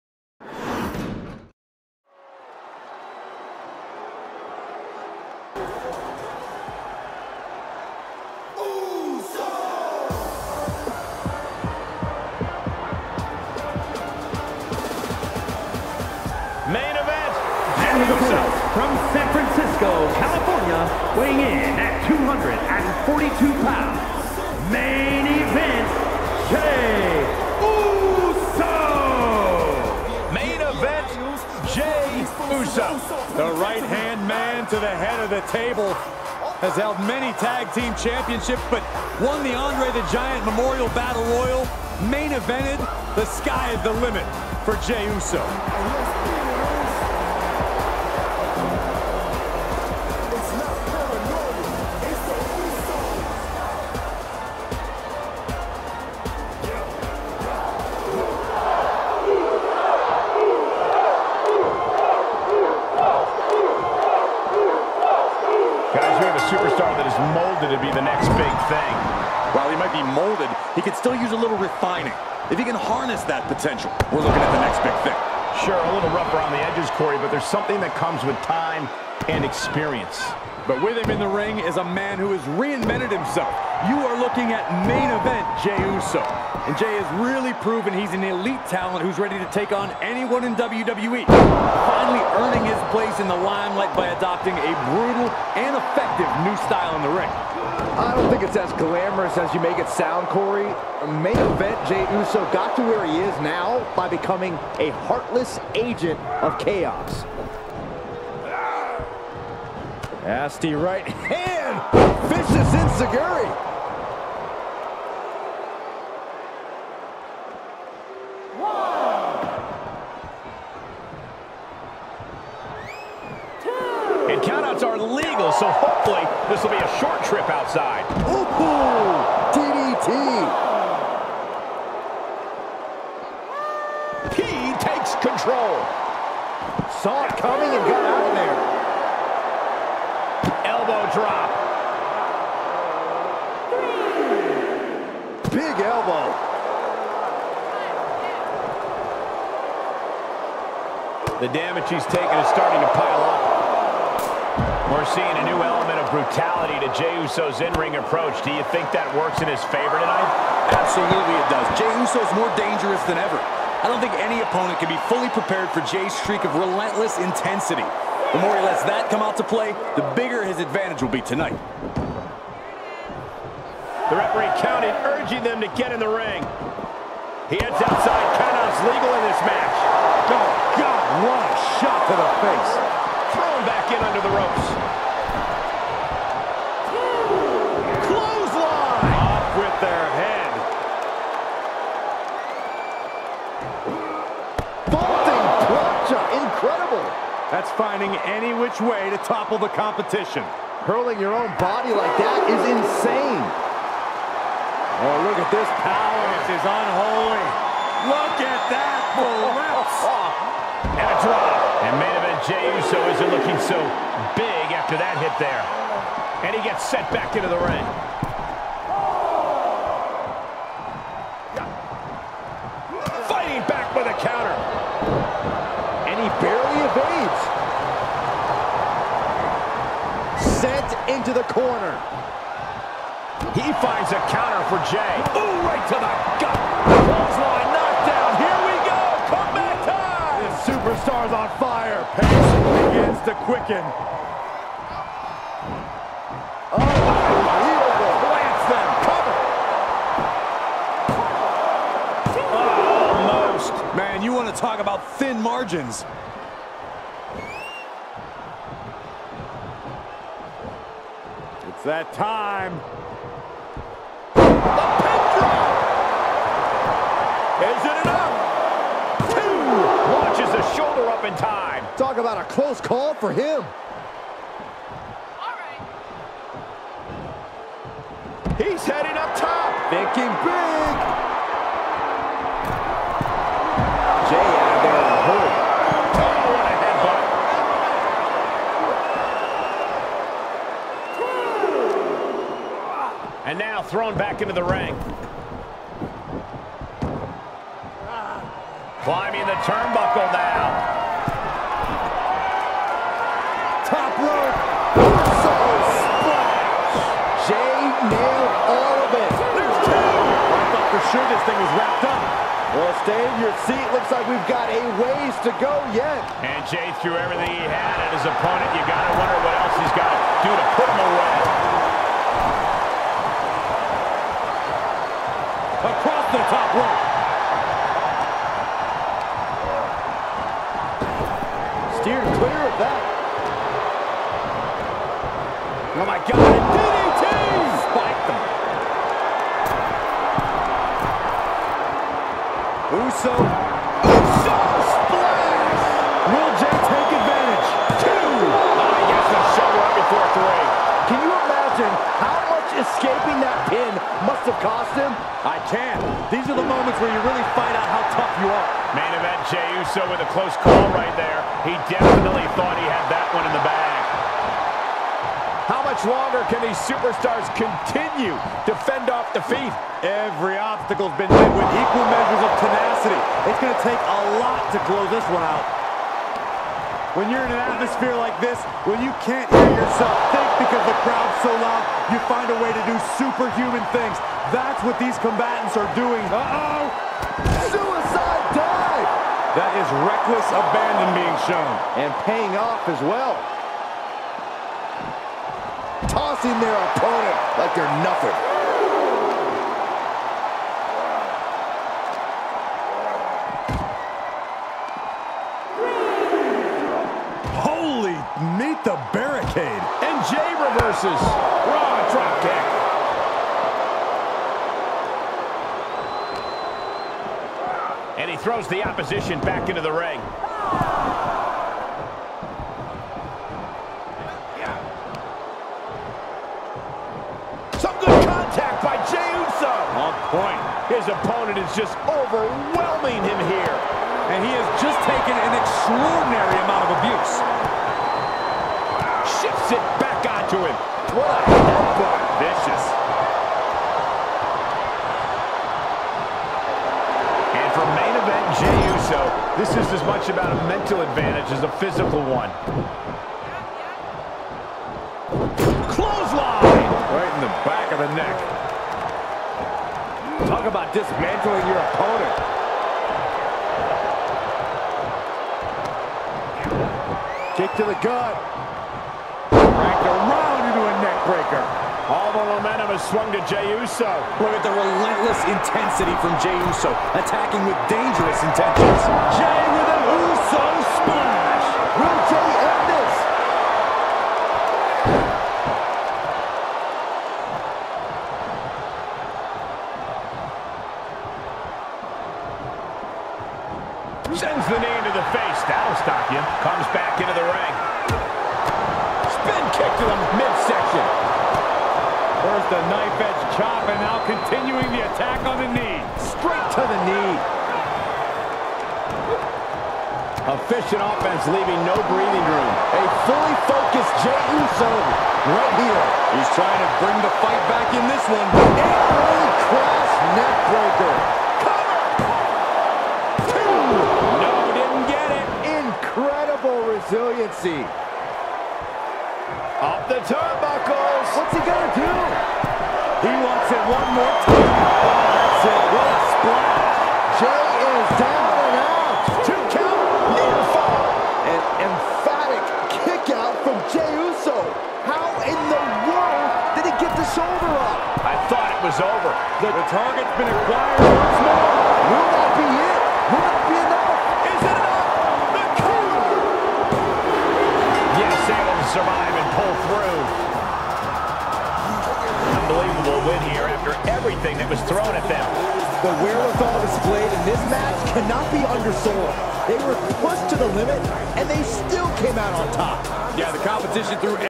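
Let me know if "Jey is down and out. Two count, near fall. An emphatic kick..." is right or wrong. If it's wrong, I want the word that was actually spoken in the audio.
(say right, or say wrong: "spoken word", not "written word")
right.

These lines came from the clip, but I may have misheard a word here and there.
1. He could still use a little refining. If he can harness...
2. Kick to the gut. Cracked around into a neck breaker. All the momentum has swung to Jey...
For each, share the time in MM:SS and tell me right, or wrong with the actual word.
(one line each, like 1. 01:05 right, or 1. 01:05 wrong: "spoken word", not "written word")
1. 01:10 right
2. 07:47 right.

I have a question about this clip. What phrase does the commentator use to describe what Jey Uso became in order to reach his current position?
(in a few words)
heartless agent of chaos.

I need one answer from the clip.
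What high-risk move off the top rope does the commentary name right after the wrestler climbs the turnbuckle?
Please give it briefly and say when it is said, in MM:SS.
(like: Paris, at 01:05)
Soul splash, at 05:05.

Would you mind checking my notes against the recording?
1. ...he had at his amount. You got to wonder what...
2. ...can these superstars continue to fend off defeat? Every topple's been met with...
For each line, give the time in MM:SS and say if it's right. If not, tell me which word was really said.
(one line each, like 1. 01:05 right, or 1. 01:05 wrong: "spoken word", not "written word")
1. 05:17 wrong: "opponent", not "amount"
2. 06:06 wrong: "obstacle", not "topple".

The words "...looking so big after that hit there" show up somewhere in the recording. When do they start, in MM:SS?
03:33.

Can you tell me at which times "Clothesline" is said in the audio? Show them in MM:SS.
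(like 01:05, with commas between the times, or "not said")
03:56, 07:35.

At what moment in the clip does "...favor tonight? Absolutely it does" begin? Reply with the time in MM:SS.
02:39.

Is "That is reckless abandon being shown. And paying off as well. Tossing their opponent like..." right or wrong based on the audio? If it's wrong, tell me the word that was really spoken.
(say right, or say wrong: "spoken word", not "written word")
right.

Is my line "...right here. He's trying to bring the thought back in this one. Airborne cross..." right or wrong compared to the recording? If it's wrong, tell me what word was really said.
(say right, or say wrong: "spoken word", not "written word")
wrong: "fight", not "thought".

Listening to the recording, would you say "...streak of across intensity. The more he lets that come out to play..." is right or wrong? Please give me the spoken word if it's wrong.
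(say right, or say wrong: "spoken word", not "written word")
wrong: "relentless", not "across".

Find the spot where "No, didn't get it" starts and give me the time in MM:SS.
08:44.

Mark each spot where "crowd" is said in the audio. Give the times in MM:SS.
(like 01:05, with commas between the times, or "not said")
06:21.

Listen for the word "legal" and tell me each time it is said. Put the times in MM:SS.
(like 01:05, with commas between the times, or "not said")
02:04, 02:58.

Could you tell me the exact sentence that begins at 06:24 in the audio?
That's what these combatants are doing.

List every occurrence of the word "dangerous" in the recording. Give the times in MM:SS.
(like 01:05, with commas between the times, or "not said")
02:42, 07:57.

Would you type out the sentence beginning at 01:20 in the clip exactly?
But with him in the ring is a man who has reinvented himself.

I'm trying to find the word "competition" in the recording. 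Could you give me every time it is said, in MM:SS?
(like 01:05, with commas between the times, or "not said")
03:19, 09:33.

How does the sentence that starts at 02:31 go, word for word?
The damage he's taken is starting to pile up.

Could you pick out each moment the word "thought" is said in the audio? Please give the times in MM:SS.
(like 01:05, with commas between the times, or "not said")
05:10, 06:02, 09:08.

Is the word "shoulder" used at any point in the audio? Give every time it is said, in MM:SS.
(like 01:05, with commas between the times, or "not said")
04:30, 09:07.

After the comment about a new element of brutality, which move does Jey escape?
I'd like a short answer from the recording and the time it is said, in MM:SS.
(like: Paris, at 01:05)
elbow drop, at 02:20.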